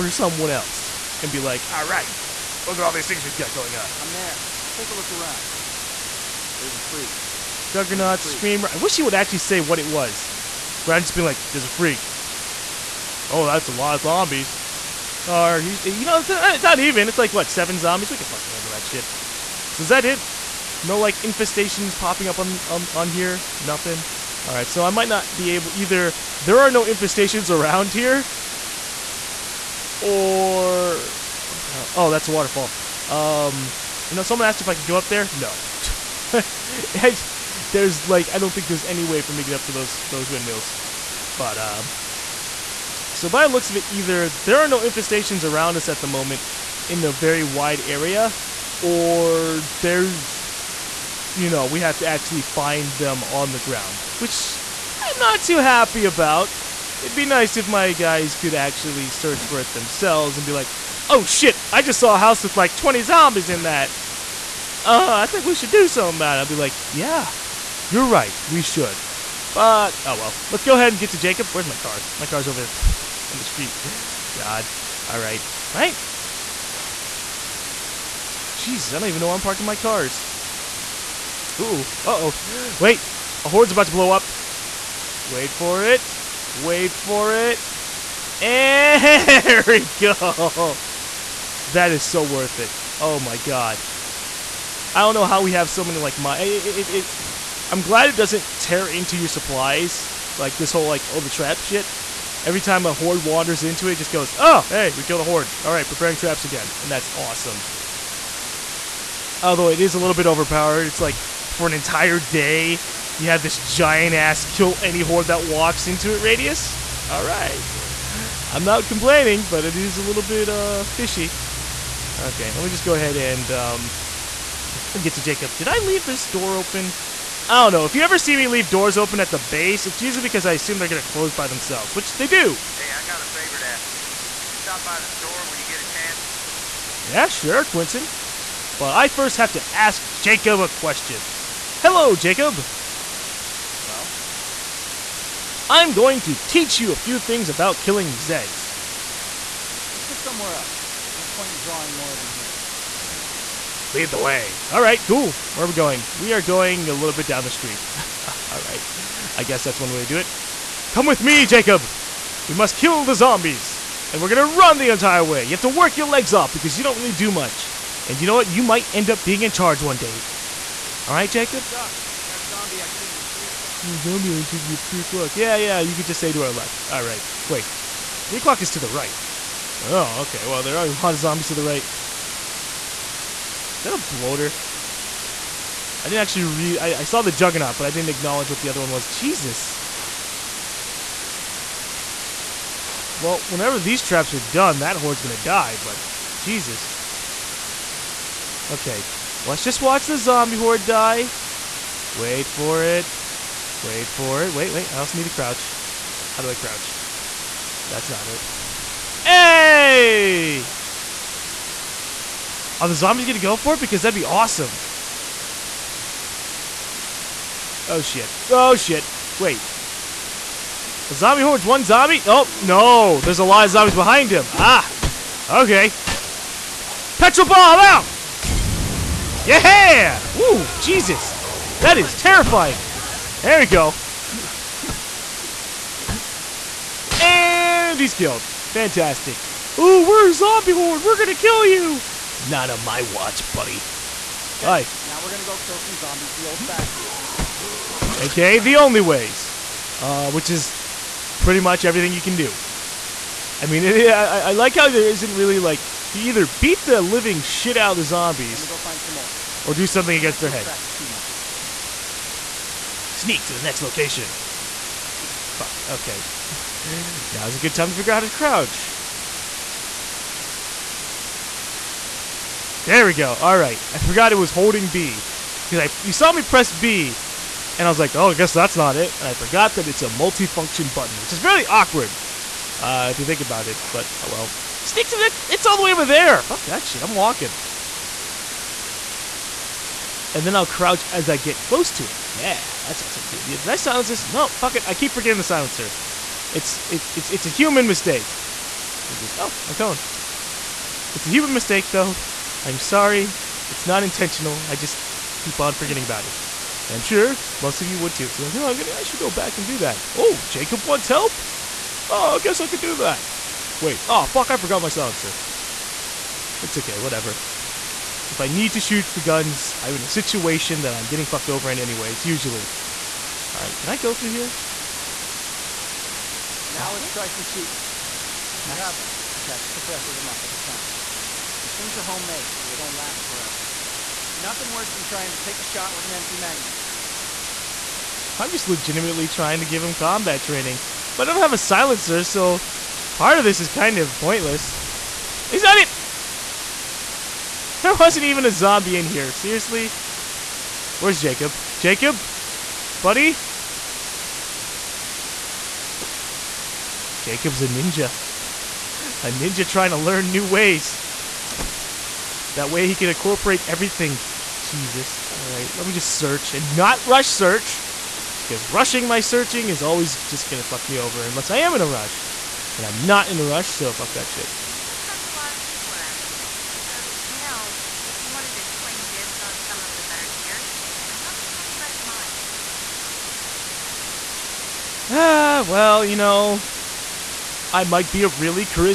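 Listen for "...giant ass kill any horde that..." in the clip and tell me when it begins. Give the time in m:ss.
1:53.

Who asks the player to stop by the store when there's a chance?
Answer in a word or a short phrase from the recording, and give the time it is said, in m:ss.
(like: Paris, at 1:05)
Quentin, at 2:17.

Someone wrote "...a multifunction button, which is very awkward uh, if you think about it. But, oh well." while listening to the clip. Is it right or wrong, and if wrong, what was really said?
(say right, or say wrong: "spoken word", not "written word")
right.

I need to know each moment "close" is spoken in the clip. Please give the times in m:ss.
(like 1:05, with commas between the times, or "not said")
2:11, 4:51.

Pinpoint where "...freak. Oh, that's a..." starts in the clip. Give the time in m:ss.
0:11.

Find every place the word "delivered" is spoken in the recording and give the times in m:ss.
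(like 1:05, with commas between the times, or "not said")
not said.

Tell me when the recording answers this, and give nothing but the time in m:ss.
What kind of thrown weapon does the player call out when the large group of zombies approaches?
3:47.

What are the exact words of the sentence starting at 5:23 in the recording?
Alright, can I go through here?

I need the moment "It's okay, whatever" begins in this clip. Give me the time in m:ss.
5:16.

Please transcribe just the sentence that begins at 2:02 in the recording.
Okay, let me just go ahead and um, get to Jacob.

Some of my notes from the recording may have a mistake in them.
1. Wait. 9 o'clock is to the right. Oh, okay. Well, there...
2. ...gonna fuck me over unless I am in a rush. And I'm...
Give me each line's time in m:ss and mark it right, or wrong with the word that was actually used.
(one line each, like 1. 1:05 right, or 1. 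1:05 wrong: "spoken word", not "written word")
1. 2:57 wrong: "3", not "9"
2. 6:10 right.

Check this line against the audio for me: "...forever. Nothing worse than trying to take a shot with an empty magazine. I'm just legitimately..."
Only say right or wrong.
right.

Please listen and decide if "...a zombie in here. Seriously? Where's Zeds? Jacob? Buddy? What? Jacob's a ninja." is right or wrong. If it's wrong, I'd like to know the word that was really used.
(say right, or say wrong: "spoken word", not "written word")
wrong: "Jacob", not "Zeds".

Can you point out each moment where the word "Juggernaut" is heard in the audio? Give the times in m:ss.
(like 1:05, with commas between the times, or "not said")
0:07, 3:07.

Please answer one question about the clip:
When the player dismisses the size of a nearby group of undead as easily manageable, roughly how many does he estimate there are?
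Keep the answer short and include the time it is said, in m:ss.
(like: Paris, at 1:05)
7, at 0:17.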